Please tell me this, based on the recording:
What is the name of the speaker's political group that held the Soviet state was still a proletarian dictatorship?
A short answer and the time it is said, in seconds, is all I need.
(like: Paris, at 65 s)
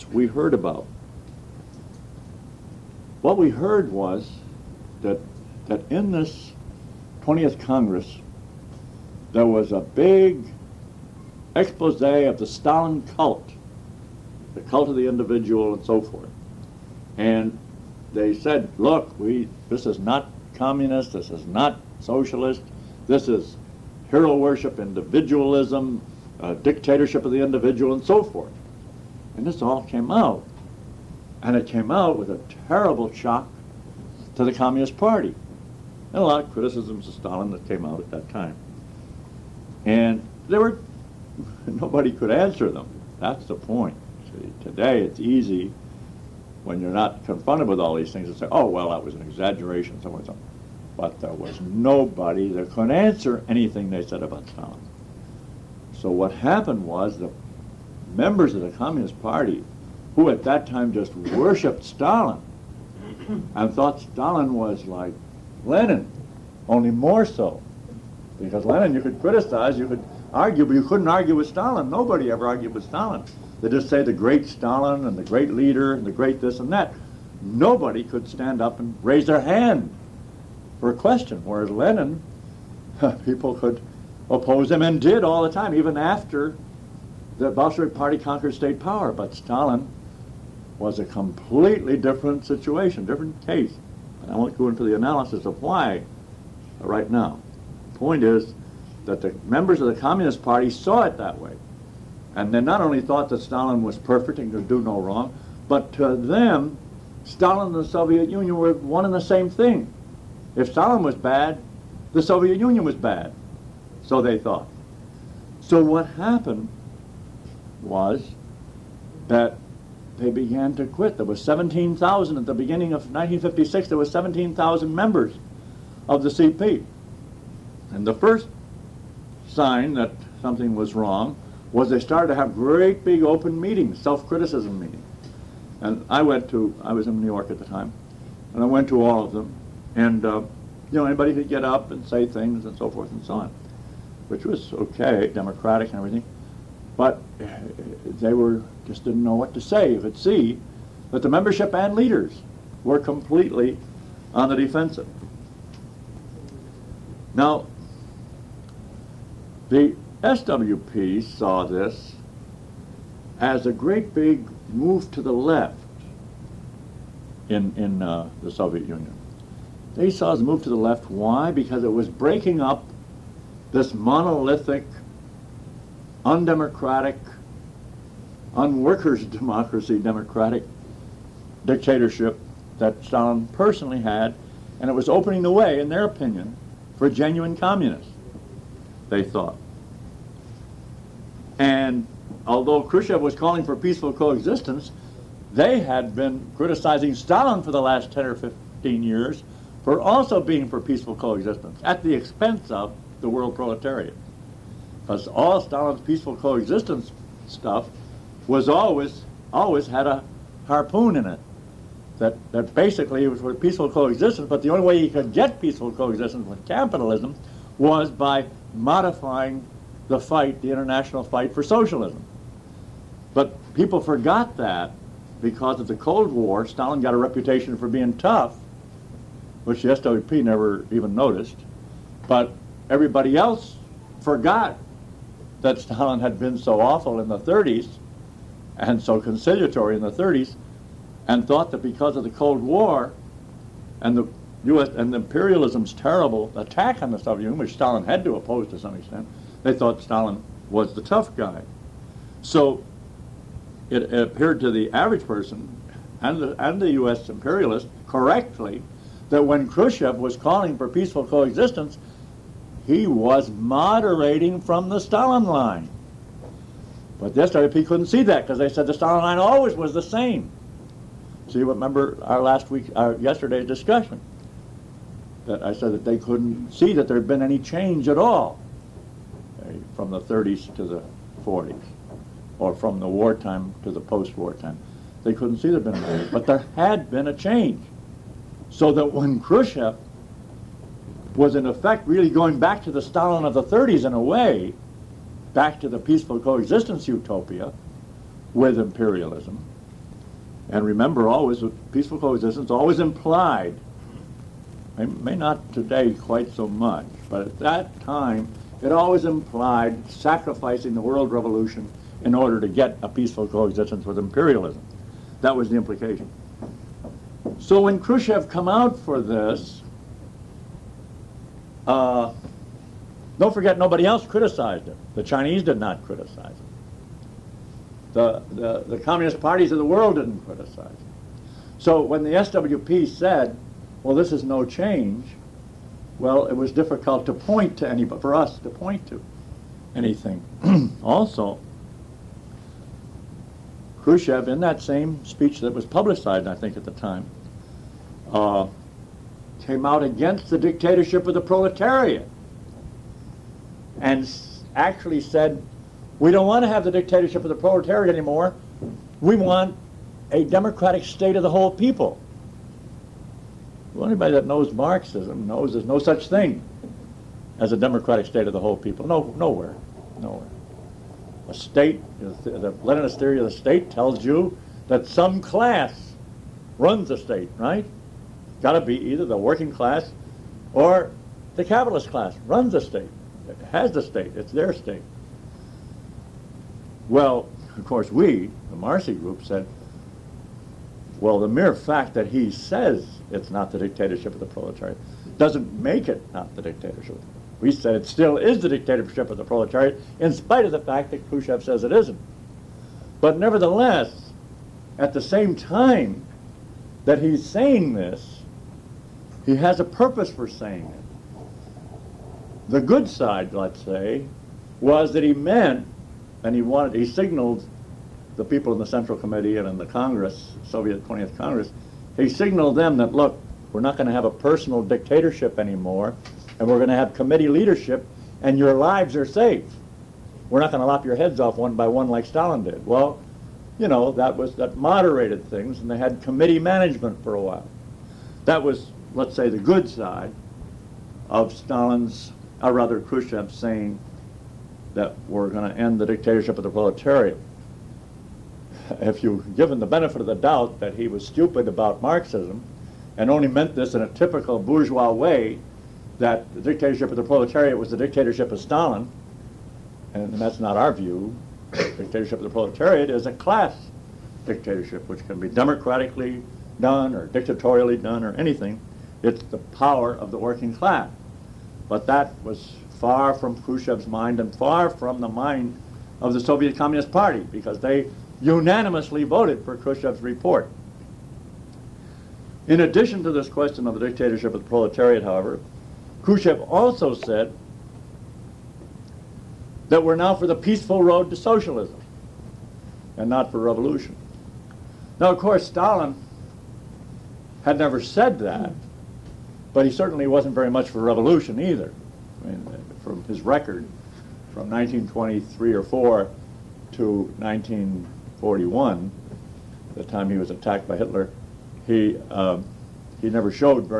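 Marcy group, at 388 s.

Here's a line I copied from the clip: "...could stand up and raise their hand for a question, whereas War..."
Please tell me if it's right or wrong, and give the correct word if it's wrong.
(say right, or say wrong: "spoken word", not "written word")
wrong: "Lenin", not "War".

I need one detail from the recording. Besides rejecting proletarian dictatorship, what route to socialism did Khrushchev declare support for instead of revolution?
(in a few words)
peaceful road.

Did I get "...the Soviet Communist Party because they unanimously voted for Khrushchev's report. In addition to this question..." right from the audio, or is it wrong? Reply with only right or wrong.
right.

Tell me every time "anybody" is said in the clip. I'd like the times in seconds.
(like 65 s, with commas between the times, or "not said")
141 s, 364 s.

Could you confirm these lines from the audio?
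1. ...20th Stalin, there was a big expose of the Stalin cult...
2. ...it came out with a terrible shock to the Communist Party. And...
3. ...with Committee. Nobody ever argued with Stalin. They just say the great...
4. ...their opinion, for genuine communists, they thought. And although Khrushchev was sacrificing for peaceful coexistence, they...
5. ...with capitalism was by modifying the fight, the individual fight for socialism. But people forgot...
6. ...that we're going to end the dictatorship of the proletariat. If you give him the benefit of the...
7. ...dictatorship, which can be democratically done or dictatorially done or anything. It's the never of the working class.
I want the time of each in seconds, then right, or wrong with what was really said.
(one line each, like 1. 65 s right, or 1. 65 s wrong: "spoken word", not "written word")
1. 7 s wrong: "Congress", not "Stalin"
2. 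31 s right
3. 71 s wrong: "Stalin", not "Committee"
4. 185 s wrong: "calling", not "sacrificing"
5. 216 s wrong: "international", not "individual"
6. 444 s right
7. 464 s wrong: "power", not "never".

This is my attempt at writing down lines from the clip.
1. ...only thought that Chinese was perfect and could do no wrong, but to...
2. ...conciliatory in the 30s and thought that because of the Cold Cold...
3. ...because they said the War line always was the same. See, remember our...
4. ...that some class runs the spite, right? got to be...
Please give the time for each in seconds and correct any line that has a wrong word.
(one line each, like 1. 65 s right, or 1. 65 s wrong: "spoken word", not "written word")
1. 102 s wrong: "Stalin", not "Chinese"
2. 239 s wrong: "War", not "Cold"
3. 268 s wrong: "Stalin", not "War"
4. 374 s wrong: "state", not "spite".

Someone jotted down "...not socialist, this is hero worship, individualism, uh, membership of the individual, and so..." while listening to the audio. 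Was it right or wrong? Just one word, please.
wrong.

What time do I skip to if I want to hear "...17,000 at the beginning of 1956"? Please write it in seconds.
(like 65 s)
121 s.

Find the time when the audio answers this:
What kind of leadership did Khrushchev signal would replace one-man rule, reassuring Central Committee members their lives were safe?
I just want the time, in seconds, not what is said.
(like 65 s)
427 s.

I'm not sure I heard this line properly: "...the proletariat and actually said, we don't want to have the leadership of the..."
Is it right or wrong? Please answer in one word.
wrong.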